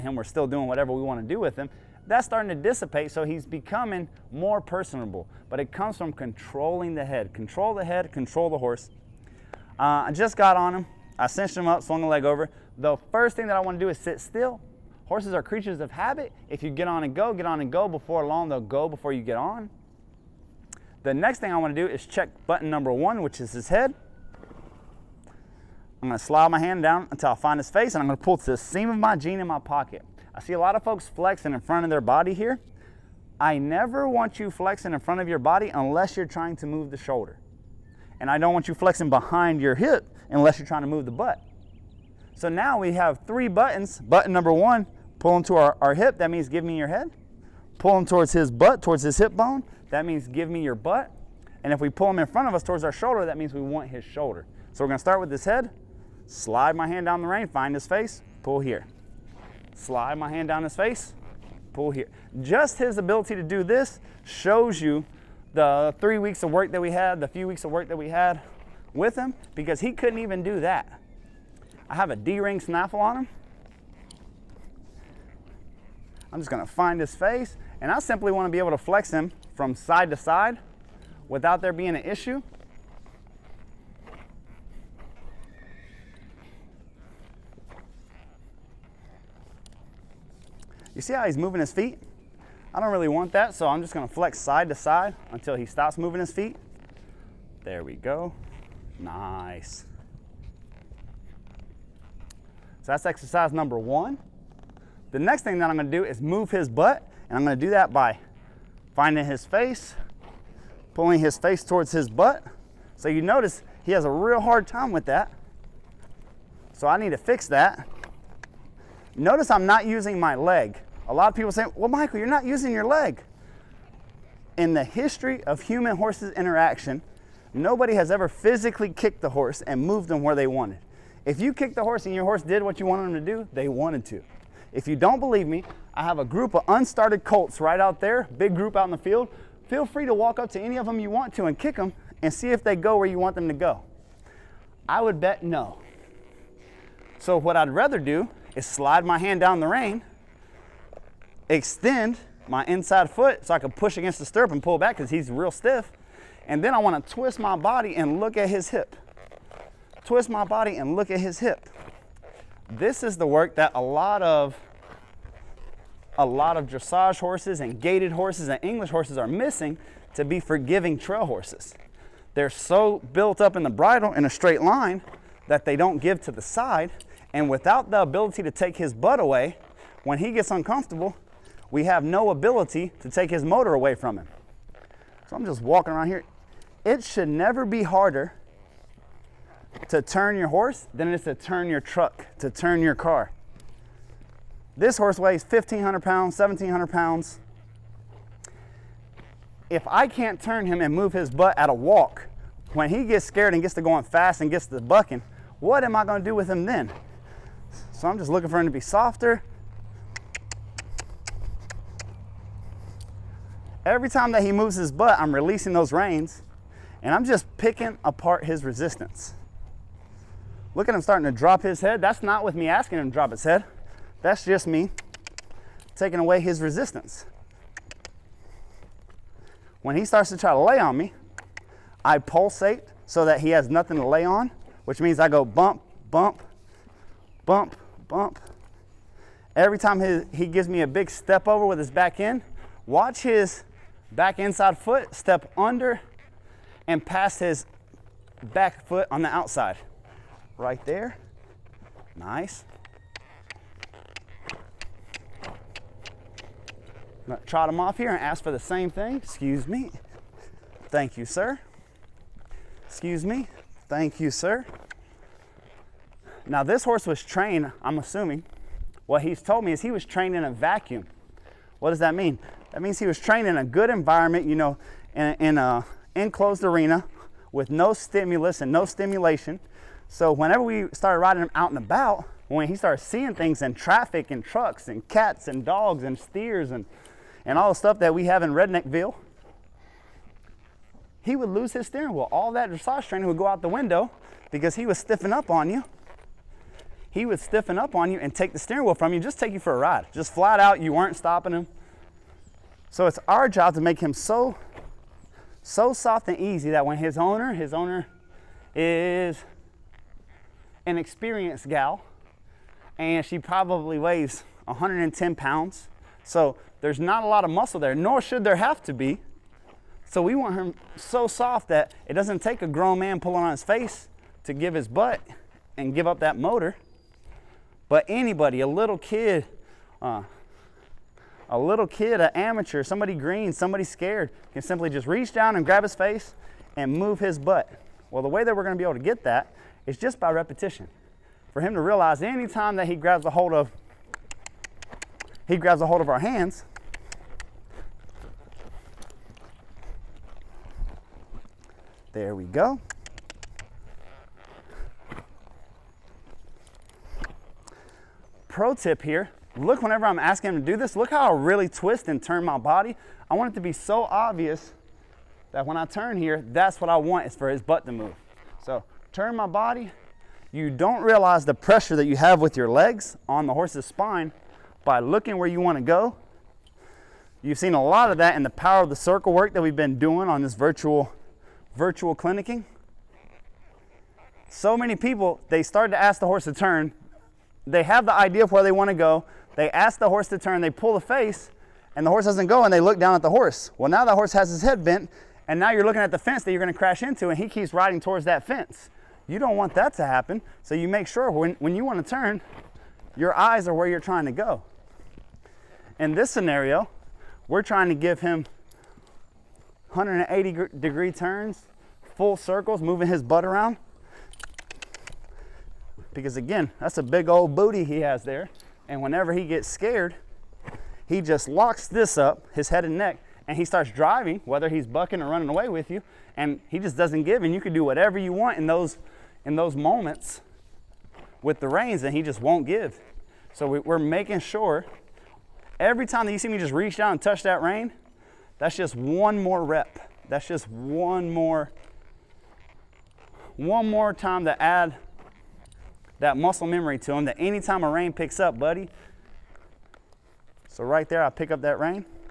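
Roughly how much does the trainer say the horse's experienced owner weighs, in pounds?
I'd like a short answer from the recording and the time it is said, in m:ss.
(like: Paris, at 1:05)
110, at 5:14.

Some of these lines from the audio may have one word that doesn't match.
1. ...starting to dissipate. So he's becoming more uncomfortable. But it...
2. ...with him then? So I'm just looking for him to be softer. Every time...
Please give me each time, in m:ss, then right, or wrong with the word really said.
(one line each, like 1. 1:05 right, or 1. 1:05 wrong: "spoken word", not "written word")
1. 0:02 wrong: "personable", not "uncomfortable"
2. 3:26 right.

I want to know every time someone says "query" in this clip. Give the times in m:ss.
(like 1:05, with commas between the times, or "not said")
not said.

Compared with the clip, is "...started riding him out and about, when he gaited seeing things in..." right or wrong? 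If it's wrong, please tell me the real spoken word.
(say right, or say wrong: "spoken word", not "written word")
wrong: "started", not "gaited".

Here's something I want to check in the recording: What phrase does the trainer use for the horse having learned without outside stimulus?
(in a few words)
trained in a vacuum.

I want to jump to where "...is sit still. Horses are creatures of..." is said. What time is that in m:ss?
0:13.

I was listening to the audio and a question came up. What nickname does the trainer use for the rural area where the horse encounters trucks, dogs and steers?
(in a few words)
Redneckville.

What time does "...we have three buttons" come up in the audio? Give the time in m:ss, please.
0:42.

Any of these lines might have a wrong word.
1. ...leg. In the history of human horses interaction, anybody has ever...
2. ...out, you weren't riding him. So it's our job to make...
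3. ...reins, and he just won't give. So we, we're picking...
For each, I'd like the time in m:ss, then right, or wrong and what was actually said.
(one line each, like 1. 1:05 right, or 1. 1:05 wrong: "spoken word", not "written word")
1. 2:02 wrong: "nobody", not "anybody"
2. 5:00 wrong: "stopping", not "riding"
3. 7:11 wrong: "making", not "picking".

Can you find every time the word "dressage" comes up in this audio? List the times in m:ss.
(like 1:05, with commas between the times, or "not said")
2:46, 4:52.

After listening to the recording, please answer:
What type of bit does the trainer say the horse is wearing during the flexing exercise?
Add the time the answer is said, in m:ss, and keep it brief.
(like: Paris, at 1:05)
D-ring snaffle, at 1:12.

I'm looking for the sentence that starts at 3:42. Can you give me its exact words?
That's not with me asking him to drop his head.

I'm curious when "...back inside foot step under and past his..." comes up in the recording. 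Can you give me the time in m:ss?
4:04.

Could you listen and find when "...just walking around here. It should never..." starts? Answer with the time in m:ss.
3:05.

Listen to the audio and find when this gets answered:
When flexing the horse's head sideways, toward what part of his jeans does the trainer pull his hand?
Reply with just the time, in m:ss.
0:28.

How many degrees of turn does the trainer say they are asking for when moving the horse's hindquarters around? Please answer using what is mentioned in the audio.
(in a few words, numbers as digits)
180.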